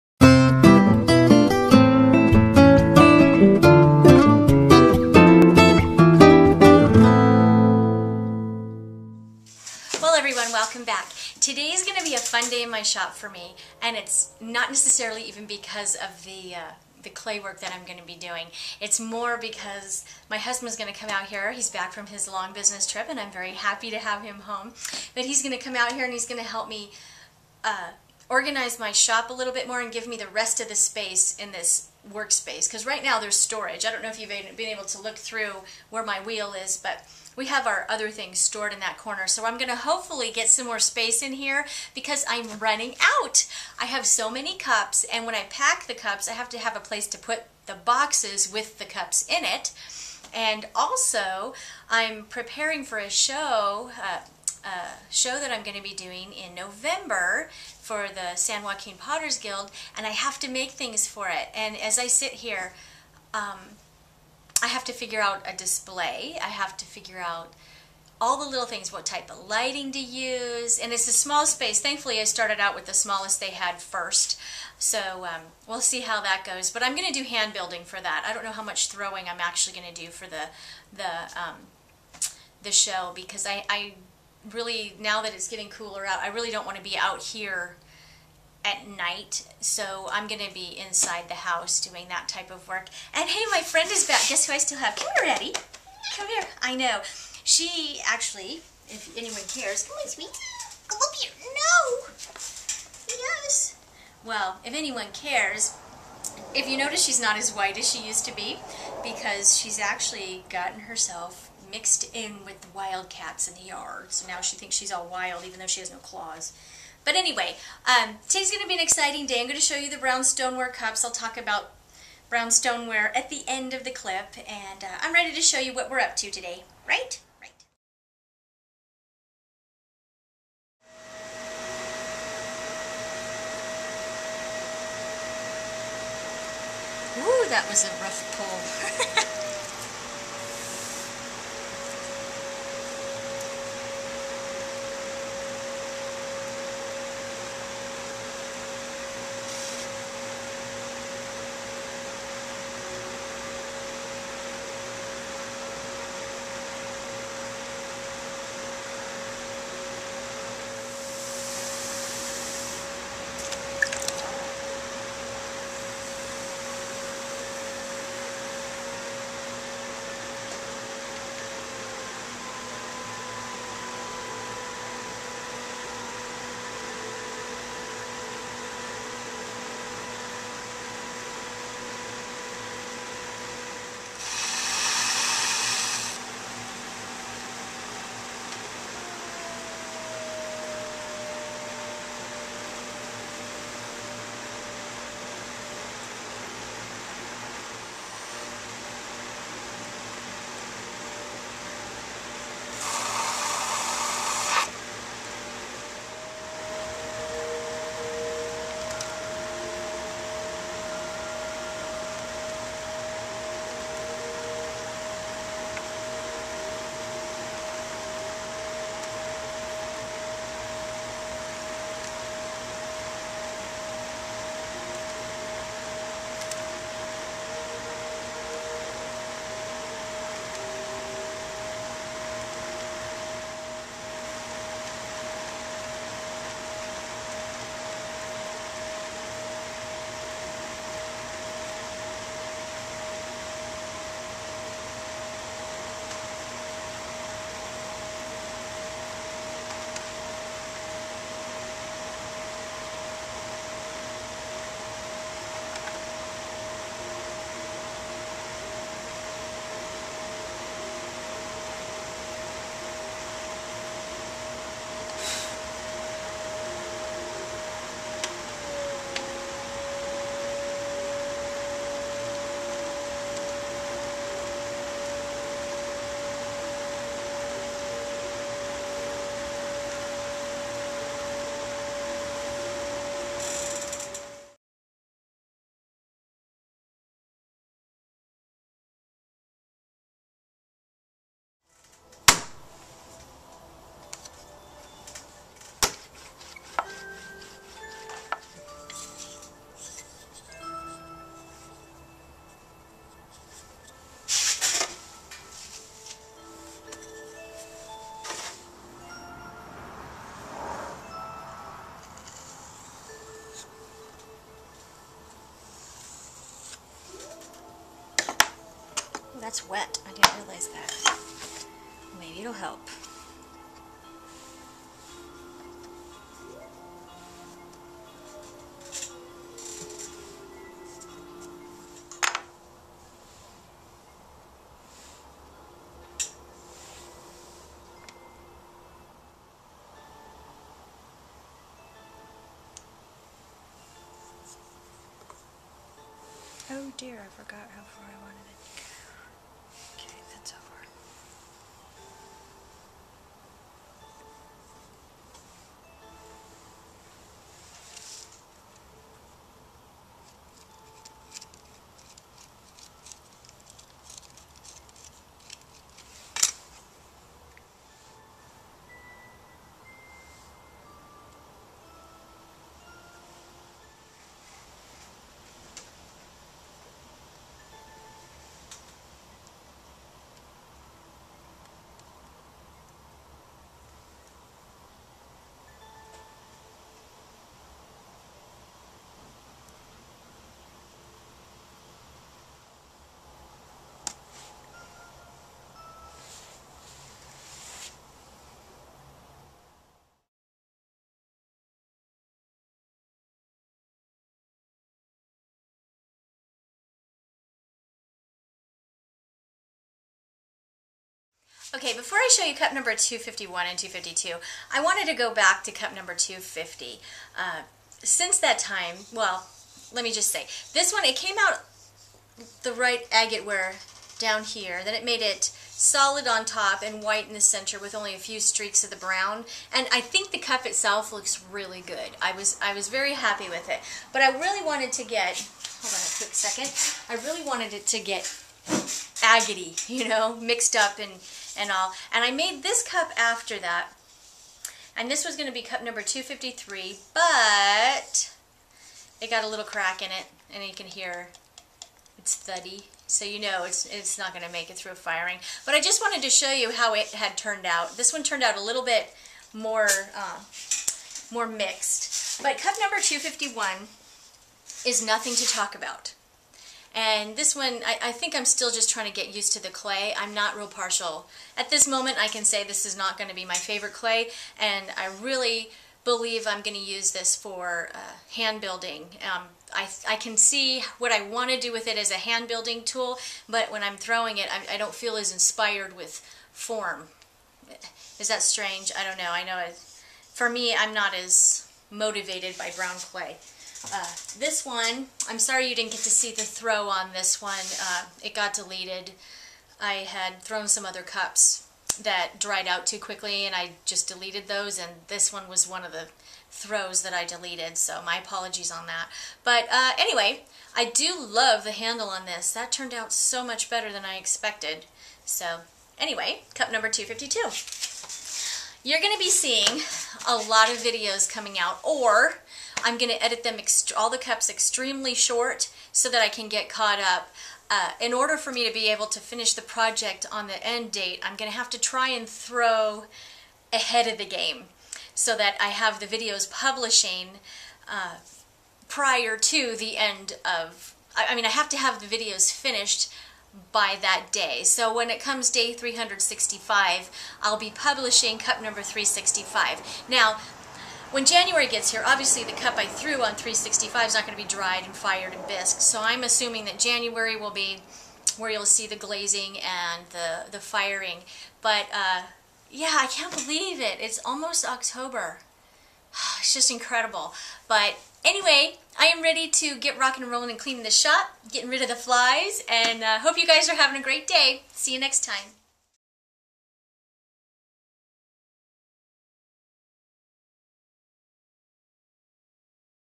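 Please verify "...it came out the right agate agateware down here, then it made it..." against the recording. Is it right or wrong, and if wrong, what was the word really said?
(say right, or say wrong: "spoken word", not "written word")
right.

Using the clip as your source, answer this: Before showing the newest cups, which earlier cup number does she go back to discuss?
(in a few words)
250.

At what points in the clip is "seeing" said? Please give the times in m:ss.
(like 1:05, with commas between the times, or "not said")
8:39.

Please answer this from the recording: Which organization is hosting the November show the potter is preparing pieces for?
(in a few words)
San Joaquin Potters Guild.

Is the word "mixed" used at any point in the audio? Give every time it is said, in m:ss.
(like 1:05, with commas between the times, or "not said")
1:51, 7:20, 7:41.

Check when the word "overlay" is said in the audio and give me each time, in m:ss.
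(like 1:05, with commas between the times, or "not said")
not said.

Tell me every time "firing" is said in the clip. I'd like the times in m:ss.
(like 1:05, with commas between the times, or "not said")
7:34, 9:20.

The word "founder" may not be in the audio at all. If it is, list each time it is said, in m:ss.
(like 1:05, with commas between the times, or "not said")
not said.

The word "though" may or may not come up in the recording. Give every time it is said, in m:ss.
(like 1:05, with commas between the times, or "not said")
1:55.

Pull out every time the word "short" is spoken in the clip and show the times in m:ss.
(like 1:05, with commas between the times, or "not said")
8:45.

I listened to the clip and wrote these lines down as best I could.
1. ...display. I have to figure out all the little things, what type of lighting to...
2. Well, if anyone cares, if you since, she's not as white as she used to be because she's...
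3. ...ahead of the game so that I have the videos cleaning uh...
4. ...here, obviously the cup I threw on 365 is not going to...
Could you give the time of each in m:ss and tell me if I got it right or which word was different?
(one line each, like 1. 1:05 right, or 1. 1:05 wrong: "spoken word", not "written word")
1. 1:05 right
2. 1:44 wrong: "notice", not "since"
3. 8:53 wrong: "publishing", not "cleaning"
4. 9:11 right.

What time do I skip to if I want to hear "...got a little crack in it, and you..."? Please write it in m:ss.
7:29.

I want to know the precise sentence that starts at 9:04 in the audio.
So when it comes day 365, I'll be publishing cup number 365.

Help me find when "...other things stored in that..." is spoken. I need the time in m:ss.
0:37.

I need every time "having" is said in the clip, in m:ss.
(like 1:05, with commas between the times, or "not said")
9:33.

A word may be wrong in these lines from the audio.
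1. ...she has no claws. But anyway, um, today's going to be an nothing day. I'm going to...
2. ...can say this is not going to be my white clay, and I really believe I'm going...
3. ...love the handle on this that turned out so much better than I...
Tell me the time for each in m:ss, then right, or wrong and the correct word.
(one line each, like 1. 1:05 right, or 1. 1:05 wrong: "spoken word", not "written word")
1. 1:55 wrong: "exciting", not "nothing"
2. 7:52 wrong: "favorite", not "white"
3. 8:31 right.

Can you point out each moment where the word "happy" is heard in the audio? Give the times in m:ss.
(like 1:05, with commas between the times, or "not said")
0:23, 7:13.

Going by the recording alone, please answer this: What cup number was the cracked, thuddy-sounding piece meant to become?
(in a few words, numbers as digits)
253.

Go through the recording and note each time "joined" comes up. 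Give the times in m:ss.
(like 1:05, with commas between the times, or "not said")
not said.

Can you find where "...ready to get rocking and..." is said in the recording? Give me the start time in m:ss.
9:29.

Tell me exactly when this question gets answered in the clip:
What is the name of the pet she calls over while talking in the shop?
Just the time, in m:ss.
1:35.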